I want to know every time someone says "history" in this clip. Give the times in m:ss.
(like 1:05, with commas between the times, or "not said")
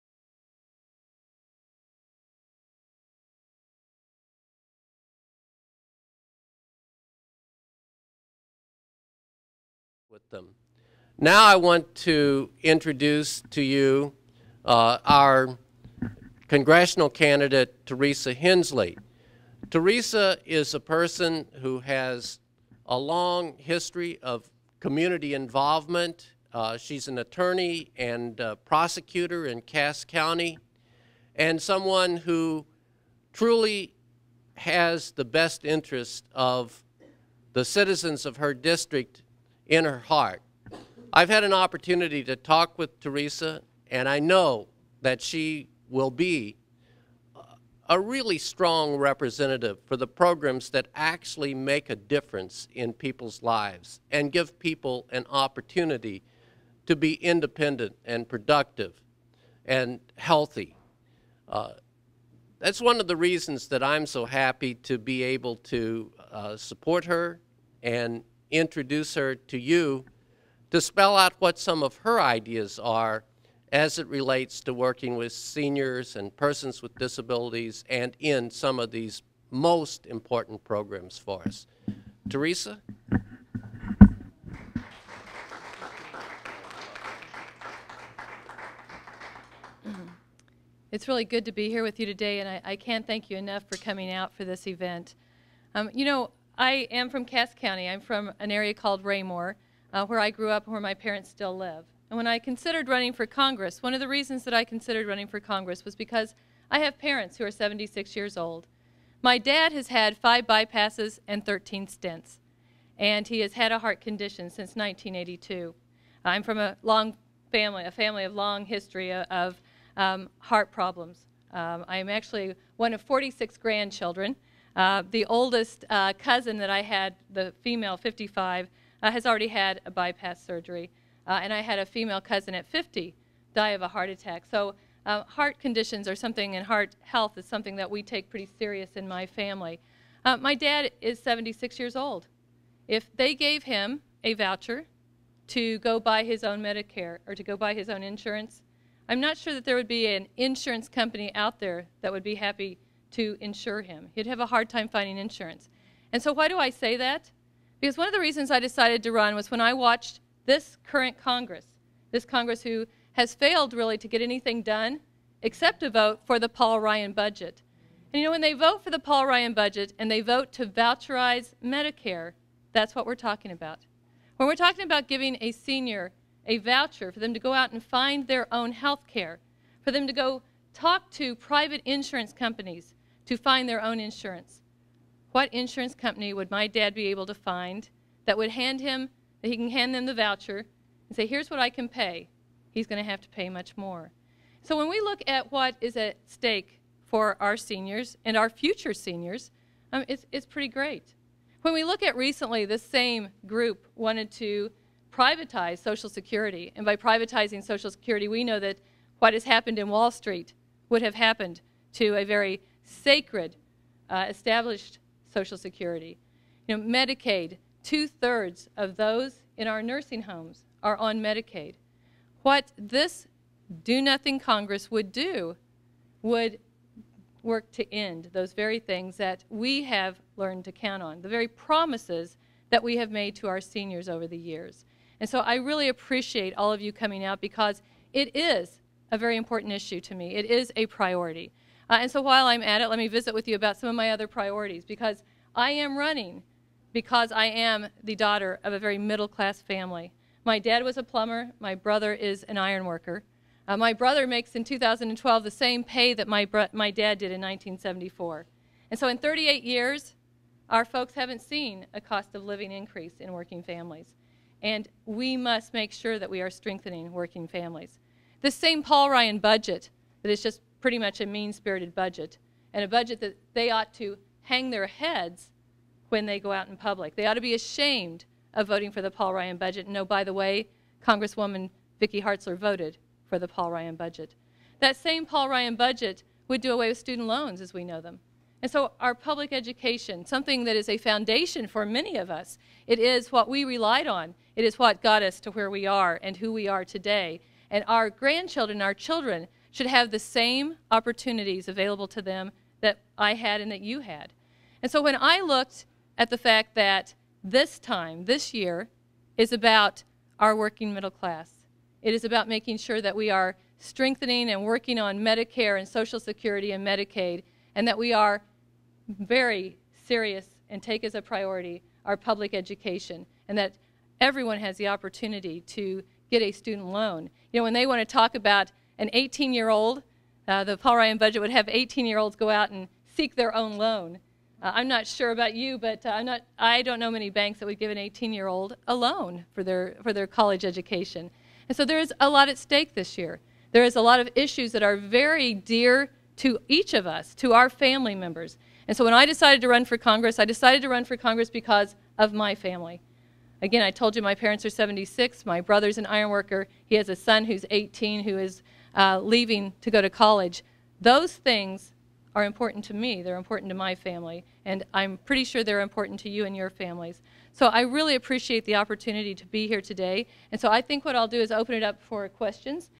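0:23, 1:58.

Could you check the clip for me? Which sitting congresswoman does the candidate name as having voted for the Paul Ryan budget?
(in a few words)
Vicki Hartzler.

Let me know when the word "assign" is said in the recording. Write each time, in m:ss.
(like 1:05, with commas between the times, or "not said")
not said.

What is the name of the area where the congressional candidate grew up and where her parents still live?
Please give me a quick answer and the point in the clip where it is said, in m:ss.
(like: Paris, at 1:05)
Raymore, at 1:39.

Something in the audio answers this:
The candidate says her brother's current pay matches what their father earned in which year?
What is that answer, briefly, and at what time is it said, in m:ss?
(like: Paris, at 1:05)
1974, at 4:17.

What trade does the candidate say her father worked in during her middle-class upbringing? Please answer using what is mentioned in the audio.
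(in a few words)
Plumber.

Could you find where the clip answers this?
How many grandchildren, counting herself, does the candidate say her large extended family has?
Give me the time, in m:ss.
2:03.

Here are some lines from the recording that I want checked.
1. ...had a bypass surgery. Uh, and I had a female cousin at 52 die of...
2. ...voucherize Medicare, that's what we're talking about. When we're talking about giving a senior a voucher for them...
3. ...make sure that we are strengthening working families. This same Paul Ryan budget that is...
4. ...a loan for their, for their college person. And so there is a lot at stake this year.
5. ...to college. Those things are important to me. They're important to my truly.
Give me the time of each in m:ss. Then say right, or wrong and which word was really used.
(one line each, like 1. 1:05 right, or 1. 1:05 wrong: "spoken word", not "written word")
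1. 2:09 wrong: "50", not "52"
2. 2:50 right
3. 4:25 right
4. 5:38 wrong: "education", not "person"
5. 6:00 wrong: "family", not "truly".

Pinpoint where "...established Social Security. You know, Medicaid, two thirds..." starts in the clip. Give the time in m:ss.
3:34.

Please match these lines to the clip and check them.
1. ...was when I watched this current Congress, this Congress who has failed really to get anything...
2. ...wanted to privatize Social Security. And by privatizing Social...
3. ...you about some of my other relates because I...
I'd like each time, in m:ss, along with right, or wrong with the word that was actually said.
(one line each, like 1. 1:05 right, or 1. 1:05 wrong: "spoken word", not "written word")
1. 2:39 right
2. 3:23 right
3. 4:03 wrong: "priorities", not "relates".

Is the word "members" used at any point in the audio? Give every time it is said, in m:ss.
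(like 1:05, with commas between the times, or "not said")
5:48.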